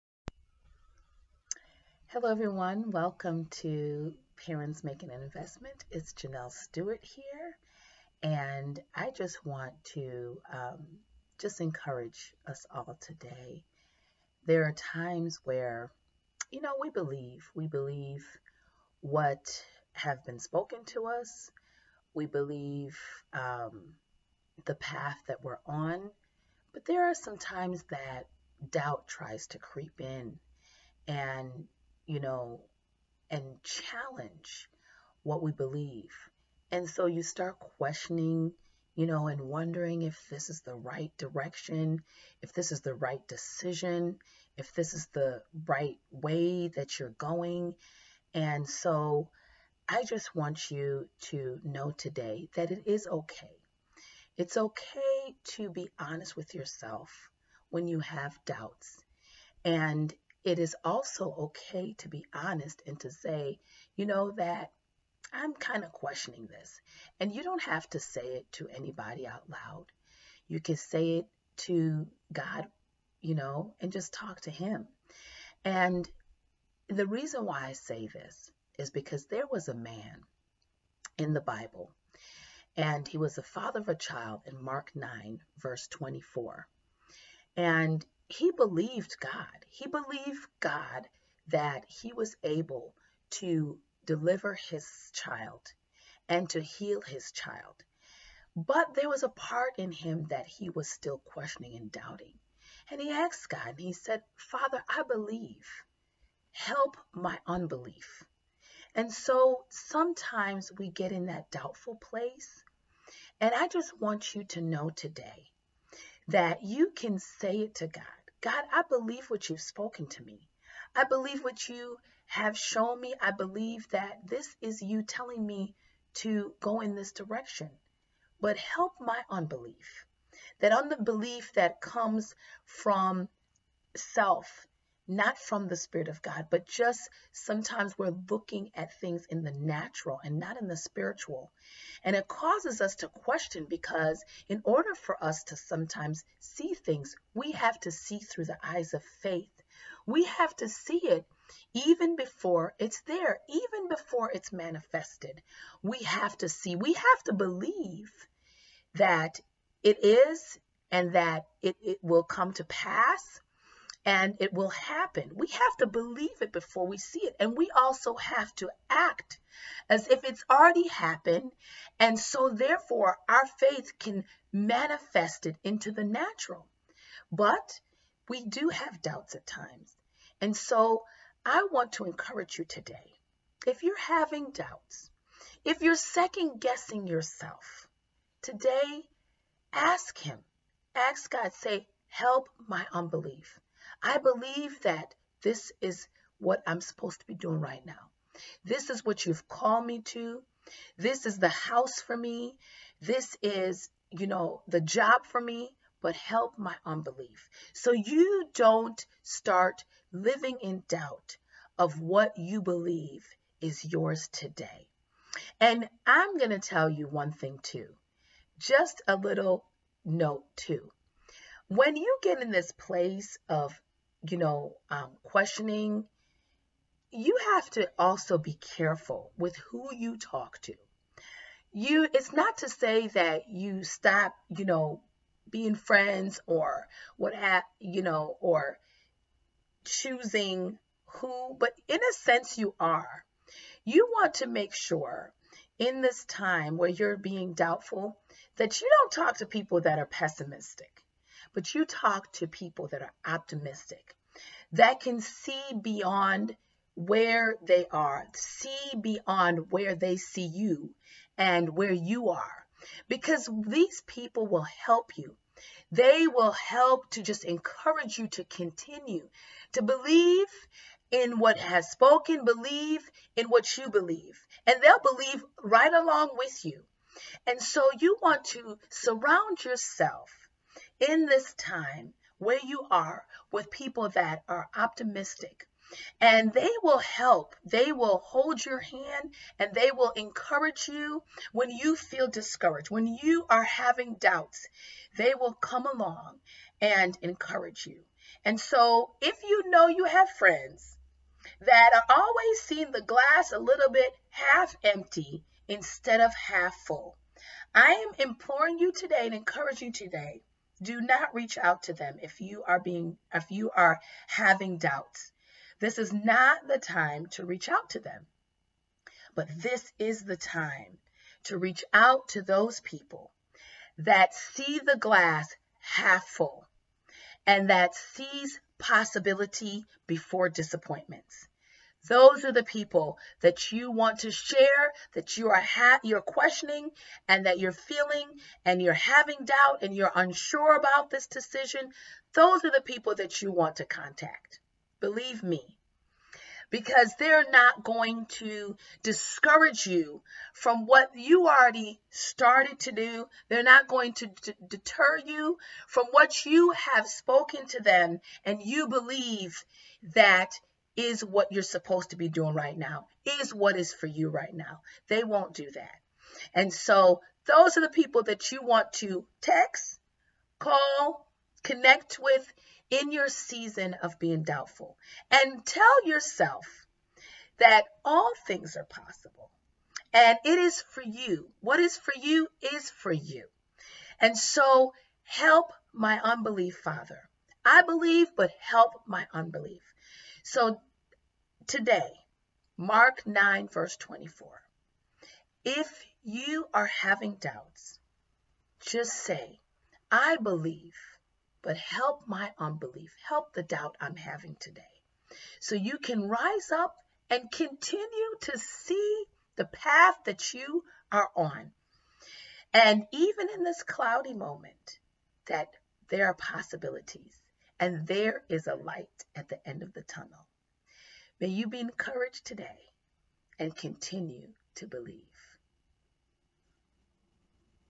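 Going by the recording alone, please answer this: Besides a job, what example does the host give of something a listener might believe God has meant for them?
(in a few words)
The house.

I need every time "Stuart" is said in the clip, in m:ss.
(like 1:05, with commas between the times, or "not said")
0:06.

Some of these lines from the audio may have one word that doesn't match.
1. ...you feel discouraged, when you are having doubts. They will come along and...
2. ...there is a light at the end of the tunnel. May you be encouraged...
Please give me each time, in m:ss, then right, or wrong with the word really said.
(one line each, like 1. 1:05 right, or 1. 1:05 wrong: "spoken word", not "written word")
1. 4:51 right
2. 6:58 right.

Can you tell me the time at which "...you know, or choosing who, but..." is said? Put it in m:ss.
3:57.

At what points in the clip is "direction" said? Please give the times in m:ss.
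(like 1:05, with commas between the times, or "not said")
0:41, 2:07.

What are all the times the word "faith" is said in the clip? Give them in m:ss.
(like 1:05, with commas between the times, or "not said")
2:29, 2:53.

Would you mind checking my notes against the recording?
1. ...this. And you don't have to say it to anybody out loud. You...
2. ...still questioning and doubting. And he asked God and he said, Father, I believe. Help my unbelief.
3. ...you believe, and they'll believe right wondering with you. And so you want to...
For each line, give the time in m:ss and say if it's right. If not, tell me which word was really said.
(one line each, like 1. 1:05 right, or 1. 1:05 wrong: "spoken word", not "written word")
1. 1:06 right
2. 1:40 right
3. 4:33 wrong: "along", not "wondering".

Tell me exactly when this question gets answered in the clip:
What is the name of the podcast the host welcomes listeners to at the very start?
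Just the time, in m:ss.
0:04.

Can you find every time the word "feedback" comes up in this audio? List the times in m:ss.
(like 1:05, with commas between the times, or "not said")
not said.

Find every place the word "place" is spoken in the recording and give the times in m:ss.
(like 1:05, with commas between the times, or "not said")
1:51, 3:42.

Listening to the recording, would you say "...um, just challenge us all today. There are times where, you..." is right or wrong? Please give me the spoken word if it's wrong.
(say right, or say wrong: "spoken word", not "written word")
wrong: "encourage", not "challenge".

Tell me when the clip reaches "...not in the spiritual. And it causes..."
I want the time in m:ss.
2:20.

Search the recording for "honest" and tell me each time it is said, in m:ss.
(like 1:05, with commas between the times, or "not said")
0:55, 1:02.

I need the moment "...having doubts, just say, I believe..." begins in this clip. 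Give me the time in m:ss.
6:36.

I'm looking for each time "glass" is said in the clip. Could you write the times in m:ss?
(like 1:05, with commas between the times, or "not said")
5:03, 5:24.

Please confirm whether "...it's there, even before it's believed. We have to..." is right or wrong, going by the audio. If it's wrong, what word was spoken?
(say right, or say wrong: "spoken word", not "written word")
wrong: "manifested", not "believed".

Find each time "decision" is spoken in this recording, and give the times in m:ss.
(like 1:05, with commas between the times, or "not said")
0:43, 5:41.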